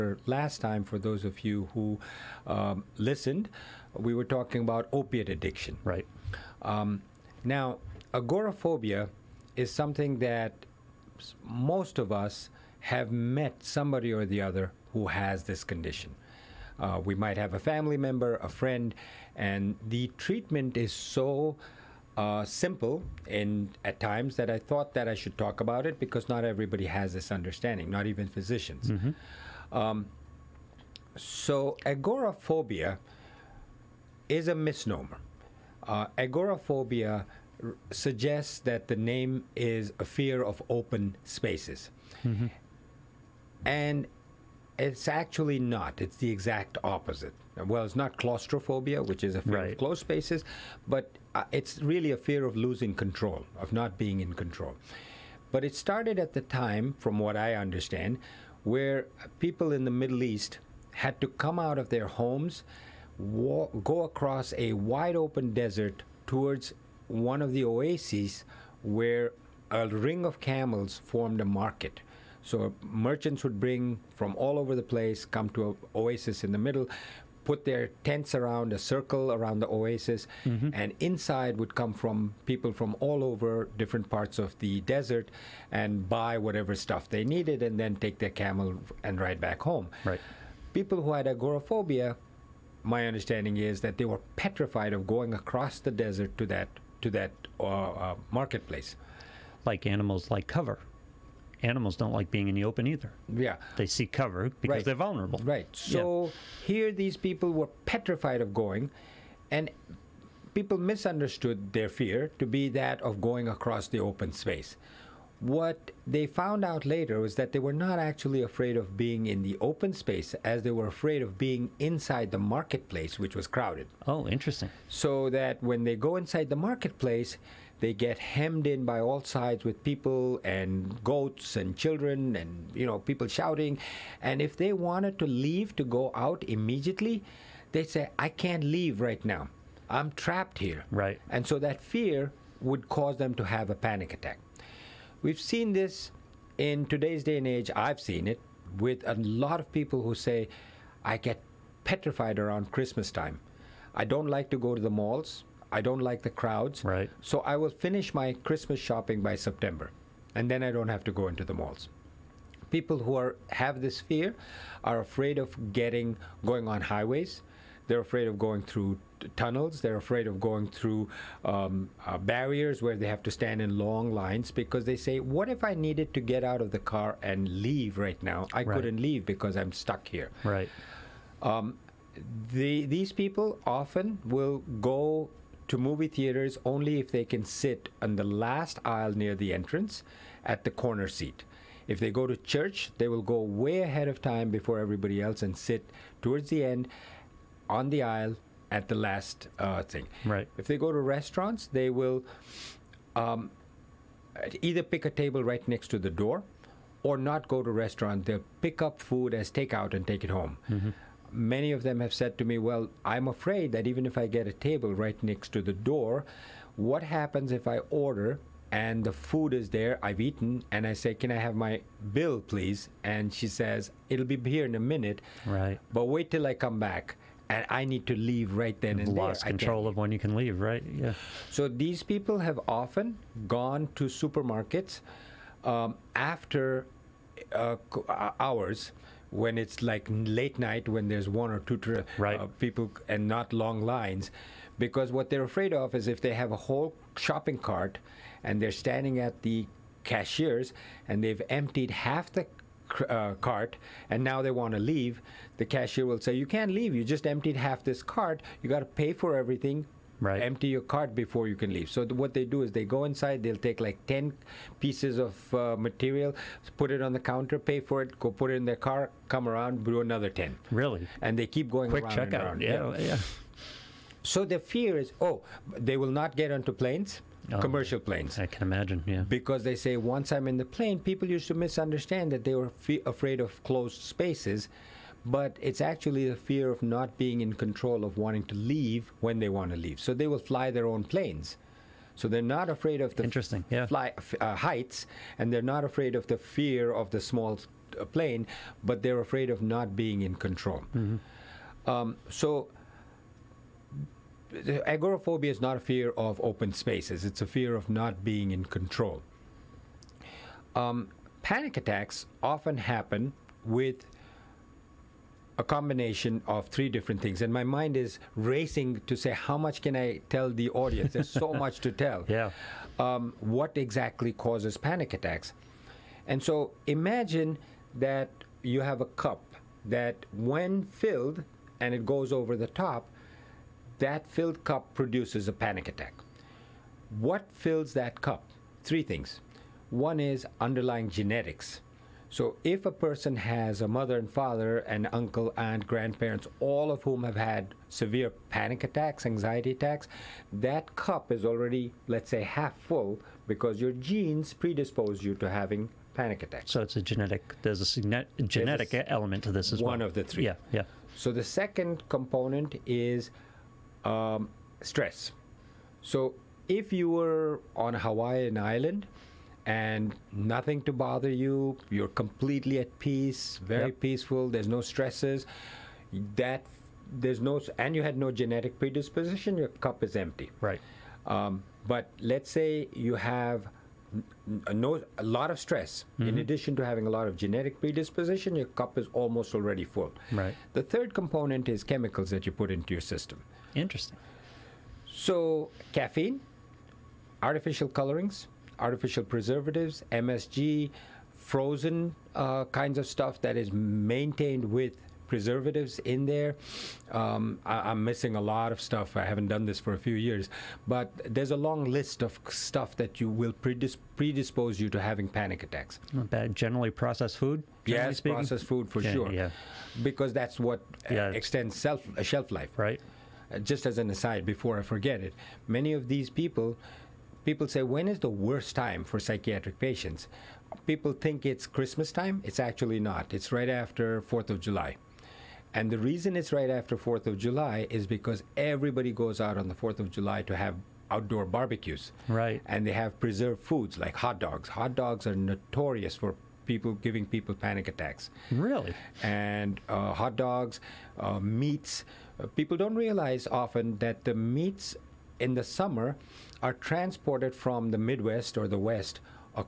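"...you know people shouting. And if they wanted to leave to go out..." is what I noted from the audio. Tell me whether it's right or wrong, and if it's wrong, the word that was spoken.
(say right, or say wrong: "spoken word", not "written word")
right.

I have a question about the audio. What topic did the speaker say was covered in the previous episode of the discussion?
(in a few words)
Opiate addiction.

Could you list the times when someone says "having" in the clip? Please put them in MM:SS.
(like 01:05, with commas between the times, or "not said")
05:55, 06:26, 06:54.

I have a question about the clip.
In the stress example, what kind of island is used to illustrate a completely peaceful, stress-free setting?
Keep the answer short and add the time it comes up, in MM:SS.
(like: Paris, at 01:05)
Hawaiian island, at 06:07.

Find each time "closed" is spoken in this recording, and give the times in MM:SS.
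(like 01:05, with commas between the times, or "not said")
00:49, 04:43.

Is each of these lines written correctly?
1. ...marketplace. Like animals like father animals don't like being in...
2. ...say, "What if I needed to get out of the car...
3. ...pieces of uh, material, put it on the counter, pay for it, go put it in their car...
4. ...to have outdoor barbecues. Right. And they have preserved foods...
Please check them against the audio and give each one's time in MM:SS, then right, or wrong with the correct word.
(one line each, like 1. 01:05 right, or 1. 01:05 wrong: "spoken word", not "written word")
1. 01:38 wrong: "cover", not "father"
2. 02:54 right
3. 04:24 right
4. 07:20 right.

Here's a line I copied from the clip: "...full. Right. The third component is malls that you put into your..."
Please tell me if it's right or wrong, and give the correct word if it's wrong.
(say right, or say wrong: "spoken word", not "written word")
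wrong: "chemicals", not "malls".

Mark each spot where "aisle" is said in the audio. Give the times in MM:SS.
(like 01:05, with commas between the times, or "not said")
03:08, 03:18.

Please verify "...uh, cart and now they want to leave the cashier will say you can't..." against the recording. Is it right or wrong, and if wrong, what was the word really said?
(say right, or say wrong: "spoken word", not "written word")
right.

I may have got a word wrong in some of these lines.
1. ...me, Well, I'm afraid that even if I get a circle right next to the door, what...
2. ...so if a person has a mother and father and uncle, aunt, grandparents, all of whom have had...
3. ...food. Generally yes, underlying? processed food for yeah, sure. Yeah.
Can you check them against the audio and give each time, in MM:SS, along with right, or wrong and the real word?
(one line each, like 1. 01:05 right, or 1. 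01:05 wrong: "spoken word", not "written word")
1. 03:32 wrong: "table", not "circle"
2. 05:42 right
3. 06:57 wrong: "speaking", not "underlying".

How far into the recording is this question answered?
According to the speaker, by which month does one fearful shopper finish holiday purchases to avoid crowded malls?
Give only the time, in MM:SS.
02:39.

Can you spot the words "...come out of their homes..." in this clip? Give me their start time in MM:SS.
01:01.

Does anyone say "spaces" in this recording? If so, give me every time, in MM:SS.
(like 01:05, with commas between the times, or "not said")
00:41, 00:49, 01:54, 01:59, 04:44, 05:06.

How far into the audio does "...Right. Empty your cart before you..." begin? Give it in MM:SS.
04:20.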